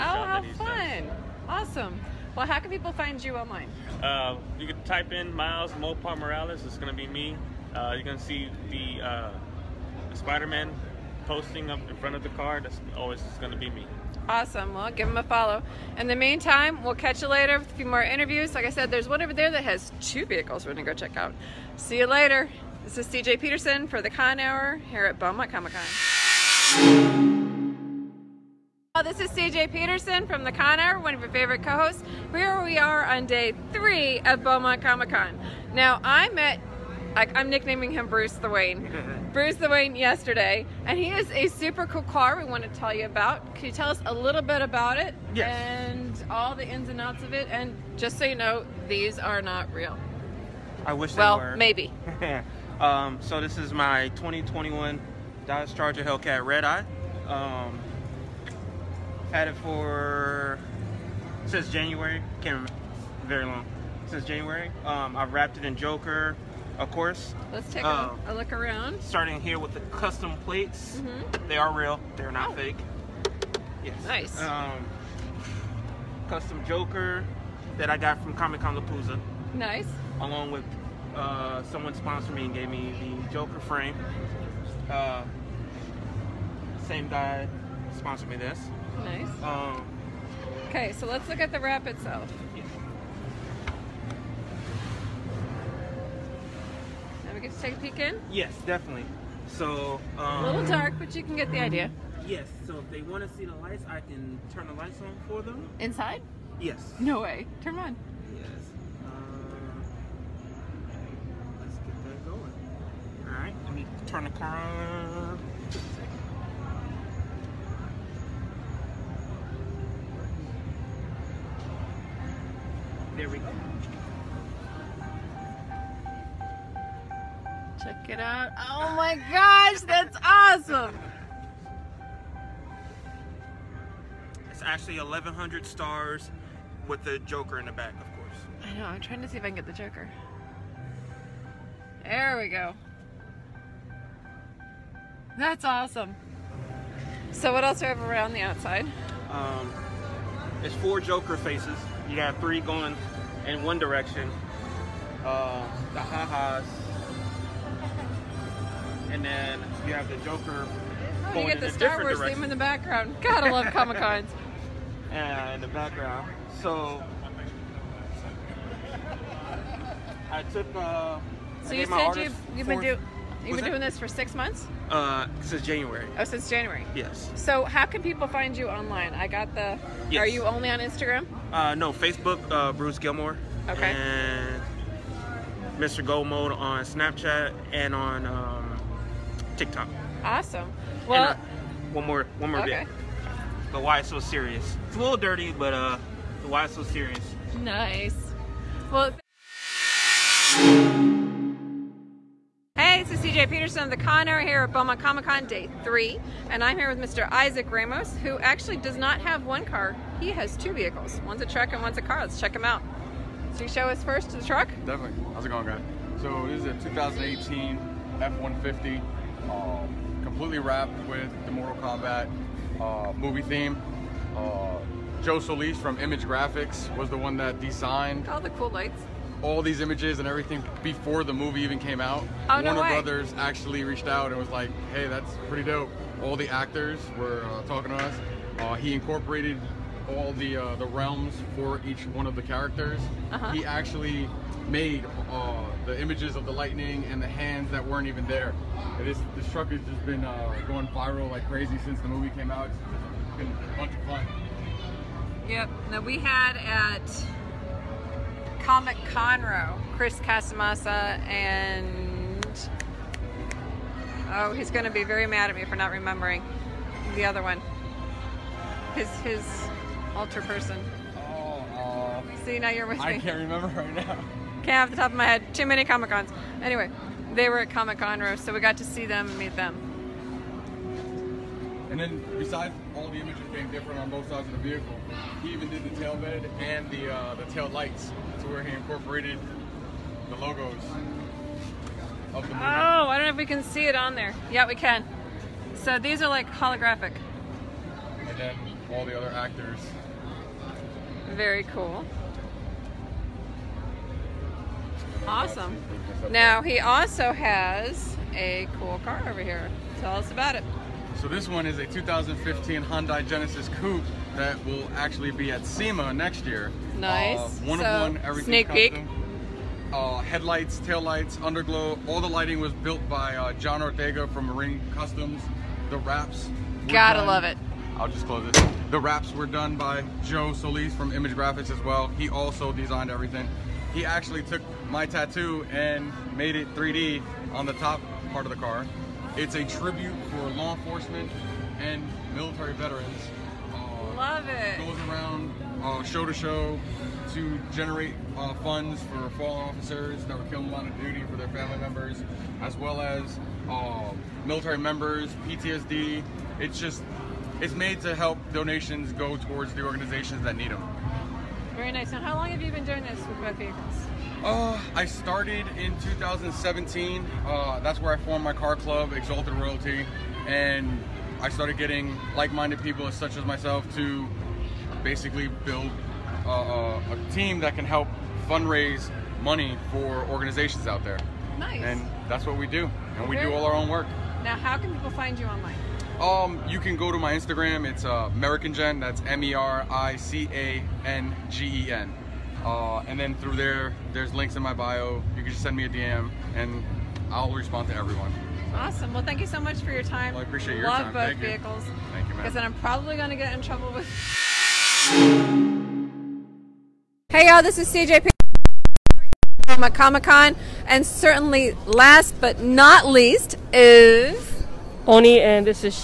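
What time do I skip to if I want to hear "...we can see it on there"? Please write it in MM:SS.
04:53.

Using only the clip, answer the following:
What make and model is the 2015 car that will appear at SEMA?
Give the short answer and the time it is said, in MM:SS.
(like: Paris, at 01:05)
Hyundai Genesis Coupe, at 05:12.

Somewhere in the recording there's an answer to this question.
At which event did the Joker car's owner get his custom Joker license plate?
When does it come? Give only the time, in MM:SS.
01:18.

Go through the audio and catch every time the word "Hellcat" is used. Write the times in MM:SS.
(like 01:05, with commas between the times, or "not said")
00:56.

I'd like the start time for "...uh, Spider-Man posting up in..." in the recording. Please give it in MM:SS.
00:09.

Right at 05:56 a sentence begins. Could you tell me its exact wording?
It's just, it's made to help donations go towards the organizations that need them.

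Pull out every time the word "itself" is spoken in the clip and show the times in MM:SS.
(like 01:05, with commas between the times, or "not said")
01:31.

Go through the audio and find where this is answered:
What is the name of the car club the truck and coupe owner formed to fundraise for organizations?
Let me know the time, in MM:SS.
06:09.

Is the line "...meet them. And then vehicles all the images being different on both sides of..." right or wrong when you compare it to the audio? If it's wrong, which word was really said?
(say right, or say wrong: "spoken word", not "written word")
wrong: "besides", not "vehicles".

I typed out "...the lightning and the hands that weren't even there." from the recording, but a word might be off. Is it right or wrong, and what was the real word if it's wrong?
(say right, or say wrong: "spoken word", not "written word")
right.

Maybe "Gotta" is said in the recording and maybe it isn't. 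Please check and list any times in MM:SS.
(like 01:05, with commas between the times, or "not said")
02:43, 05:26.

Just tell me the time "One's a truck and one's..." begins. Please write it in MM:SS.
03:31.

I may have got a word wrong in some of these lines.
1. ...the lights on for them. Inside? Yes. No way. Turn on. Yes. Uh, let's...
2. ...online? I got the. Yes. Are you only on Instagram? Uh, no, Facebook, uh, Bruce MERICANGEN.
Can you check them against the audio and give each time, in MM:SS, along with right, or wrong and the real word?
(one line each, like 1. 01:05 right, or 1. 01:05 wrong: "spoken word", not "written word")
1. 01:44 right
2. 02:58 wrong: "Gilmore", not "MERICANGEN".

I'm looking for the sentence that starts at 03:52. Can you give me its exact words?
Oh, Warner Brothers actually reached out and was like, "Hey, that's pretty dope." All the actors were uh, talking to us.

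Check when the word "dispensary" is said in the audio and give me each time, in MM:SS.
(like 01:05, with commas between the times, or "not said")
not said.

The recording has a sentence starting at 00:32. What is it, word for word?
Here we are on day three of Beaumont Comic Con.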